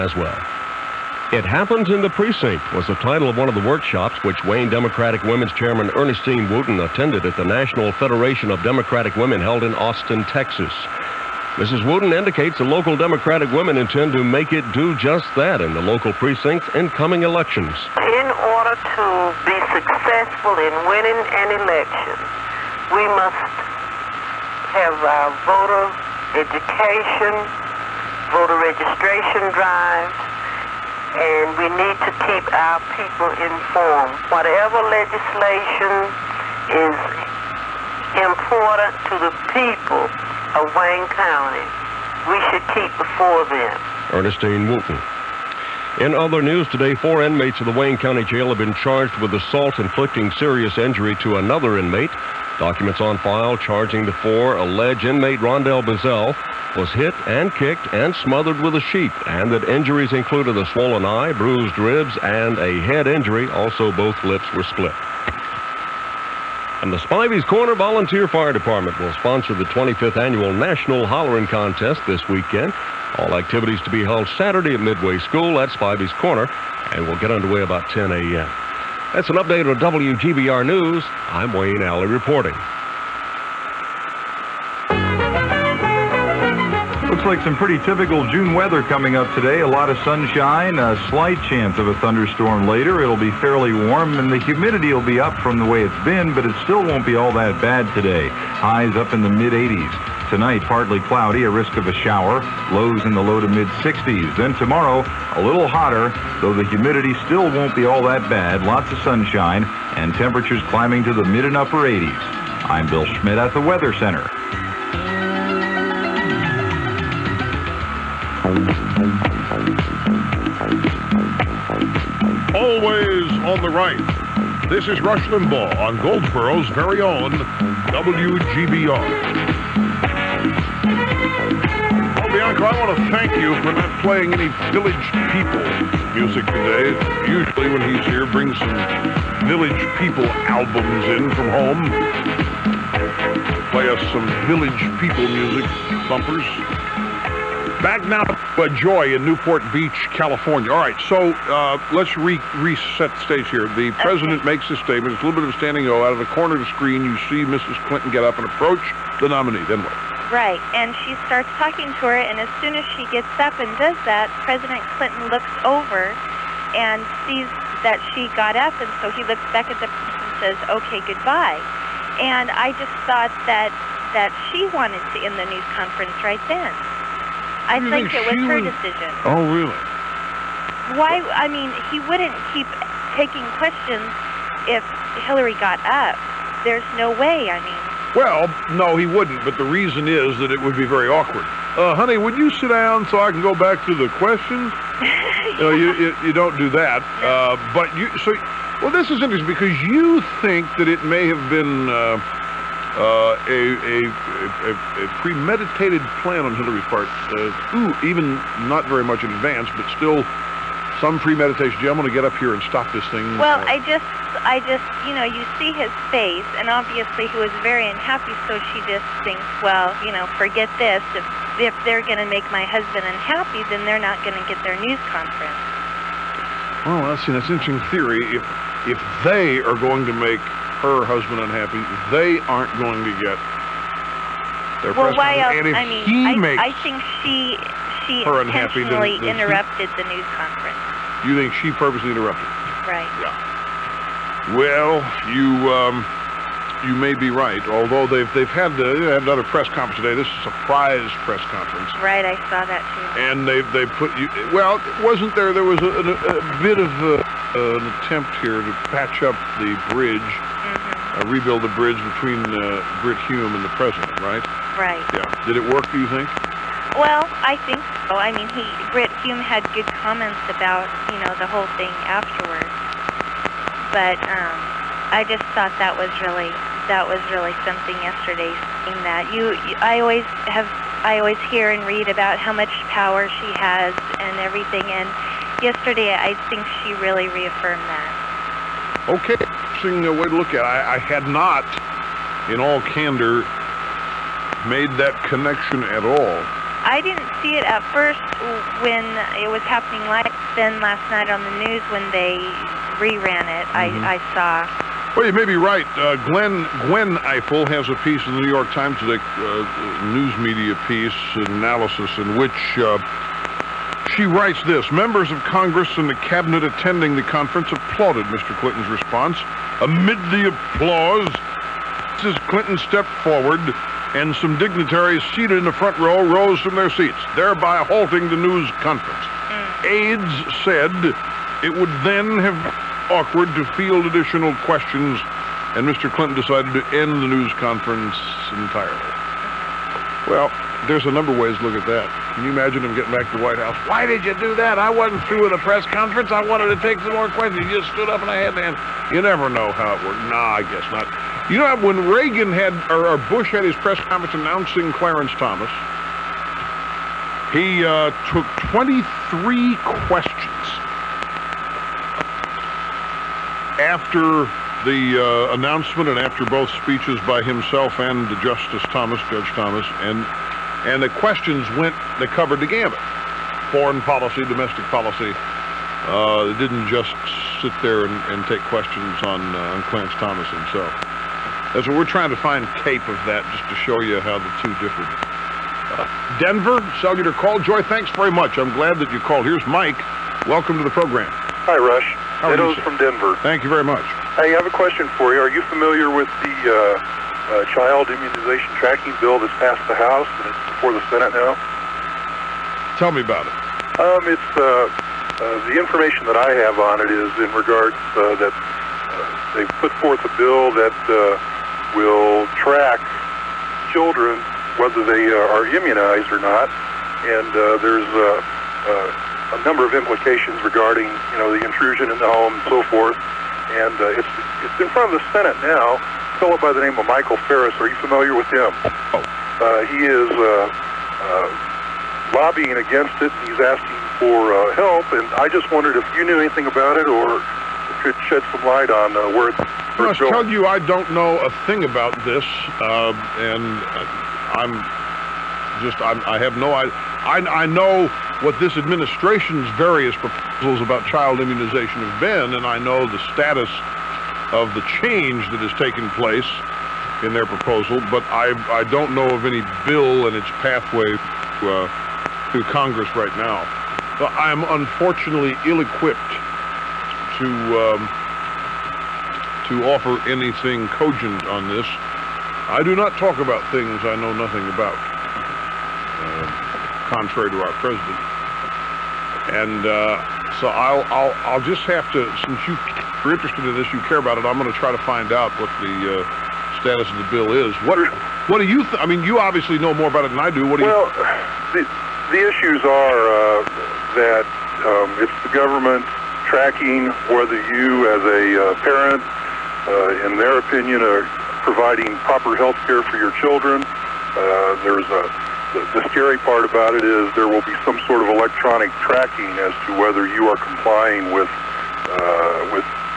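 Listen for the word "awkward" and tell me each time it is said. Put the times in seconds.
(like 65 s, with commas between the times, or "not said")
191 s, 333 s.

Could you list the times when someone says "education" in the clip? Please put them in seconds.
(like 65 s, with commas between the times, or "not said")
26 s.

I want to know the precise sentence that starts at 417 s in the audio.
And uh, there's uh, uh, a number of implications regarding, you know, the intrusion in the home and so forth.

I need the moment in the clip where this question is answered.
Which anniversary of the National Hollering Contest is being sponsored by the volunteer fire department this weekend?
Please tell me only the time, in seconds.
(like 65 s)
69 s.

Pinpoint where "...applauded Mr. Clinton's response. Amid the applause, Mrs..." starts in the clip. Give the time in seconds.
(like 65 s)
317 s.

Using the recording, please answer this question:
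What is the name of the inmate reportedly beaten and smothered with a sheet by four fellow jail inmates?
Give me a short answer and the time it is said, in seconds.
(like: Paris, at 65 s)
Rondell Bazell, at 55 s.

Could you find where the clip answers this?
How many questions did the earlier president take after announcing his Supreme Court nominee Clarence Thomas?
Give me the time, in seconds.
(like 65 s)
358 s.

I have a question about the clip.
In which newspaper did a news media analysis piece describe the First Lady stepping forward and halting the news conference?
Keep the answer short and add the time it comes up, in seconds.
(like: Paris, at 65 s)
New York Times, at 308 s.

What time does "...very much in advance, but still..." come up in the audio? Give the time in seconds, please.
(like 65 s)
208 s.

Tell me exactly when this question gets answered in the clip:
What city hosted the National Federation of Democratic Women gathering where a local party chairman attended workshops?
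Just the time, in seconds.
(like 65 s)
9 s.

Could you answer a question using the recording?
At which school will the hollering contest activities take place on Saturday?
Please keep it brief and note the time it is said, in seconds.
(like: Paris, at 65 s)
Midway School, at 74 s.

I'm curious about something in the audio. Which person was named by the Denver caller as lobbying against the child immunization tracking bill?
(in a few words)
Michael Farris.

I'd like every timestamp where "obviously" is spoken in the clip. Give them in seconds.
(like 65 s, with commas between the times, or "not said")
216 s, 489 s.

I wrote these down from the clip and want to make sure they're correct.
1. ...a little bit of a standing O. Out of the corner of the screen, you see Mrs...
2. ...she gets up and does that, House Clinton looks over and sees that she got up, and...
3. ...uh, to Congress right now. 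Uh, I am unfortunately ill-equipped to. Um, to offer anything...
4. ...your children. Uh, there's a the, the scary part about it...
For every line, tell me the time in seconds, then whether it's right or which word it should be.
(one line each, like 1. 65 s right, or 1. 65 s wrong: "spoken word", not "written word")
1. 155 s right
2. 162 s wrong: "President", not "House"
3. 461 s right
4. 503 s right.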